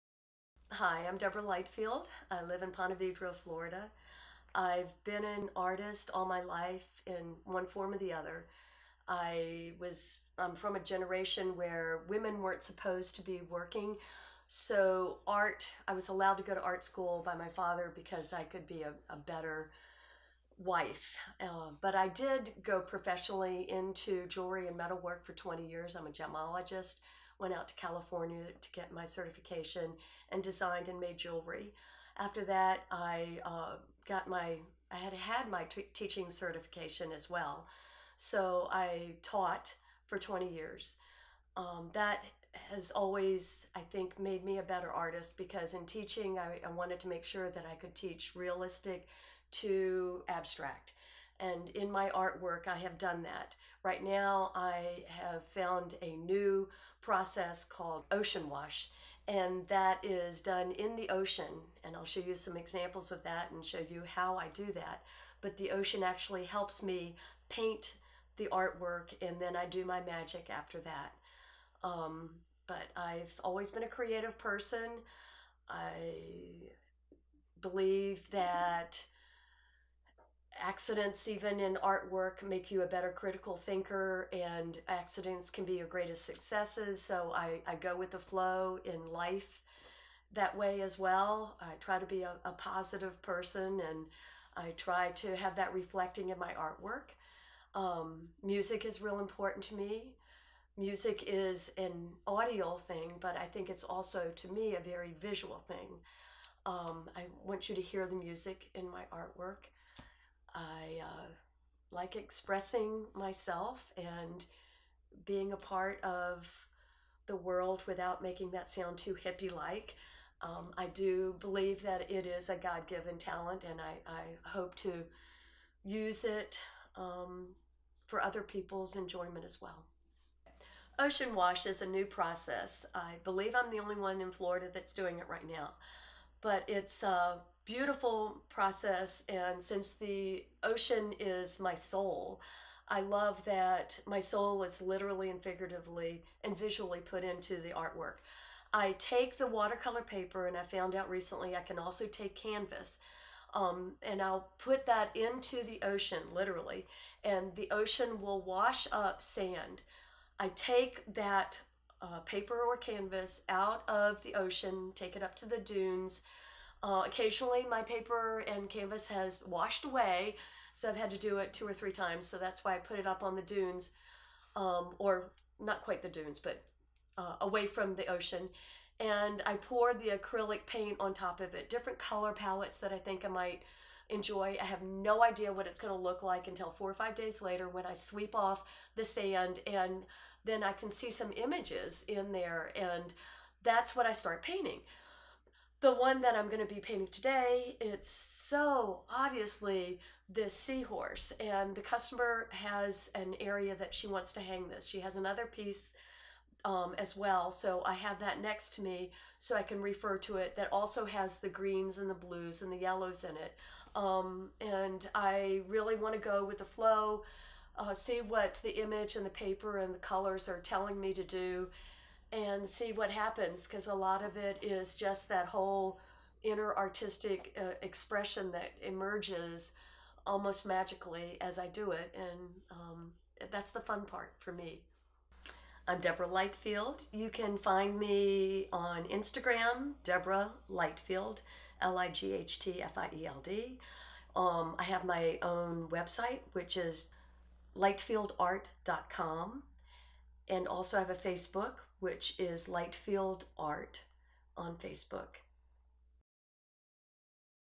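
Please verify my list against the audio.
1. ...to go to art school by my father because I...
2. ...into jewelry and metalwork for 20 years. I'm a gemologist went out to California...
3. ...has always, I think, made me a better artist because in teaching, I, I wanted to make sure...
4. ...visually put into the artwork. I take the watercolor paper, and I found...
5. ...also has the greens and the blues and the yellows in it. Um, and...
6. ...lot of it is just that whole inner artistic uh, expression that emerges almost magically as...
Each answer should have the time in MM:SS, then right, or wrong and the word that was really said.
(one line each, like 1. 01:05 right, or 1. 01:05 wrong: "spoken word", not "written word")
1. 00:16 right
2. 00:23 right
3. 00:42 right
4. 02:26 right
5. 03:30 right
6. 03:43 right.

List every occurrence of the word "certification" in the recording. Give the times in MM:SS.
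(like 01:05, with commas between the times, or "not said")
00:29, 00:36.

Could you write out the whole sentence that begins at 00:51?
And in my artwork, I have done that.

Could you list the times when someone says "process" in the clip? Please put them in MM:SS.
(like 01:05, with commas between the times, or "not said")
00:57, 02:12, 02:18.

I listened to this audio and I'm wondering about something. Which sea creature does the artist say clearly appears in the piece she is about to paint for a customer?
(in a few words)
Seahorse.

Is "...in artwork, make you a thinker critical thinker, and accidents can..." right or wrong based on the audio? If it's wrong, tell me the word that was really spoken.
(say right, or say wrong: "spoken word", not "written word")
wrong: "better", not "thinker".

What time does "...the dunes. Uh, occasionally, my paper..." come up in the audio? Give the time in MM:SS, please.
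02:45.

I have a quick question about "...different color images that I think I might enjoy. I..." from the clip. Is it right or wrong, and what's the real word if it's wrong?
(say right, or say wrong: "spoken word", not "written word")
wrong: "palettes", not "images".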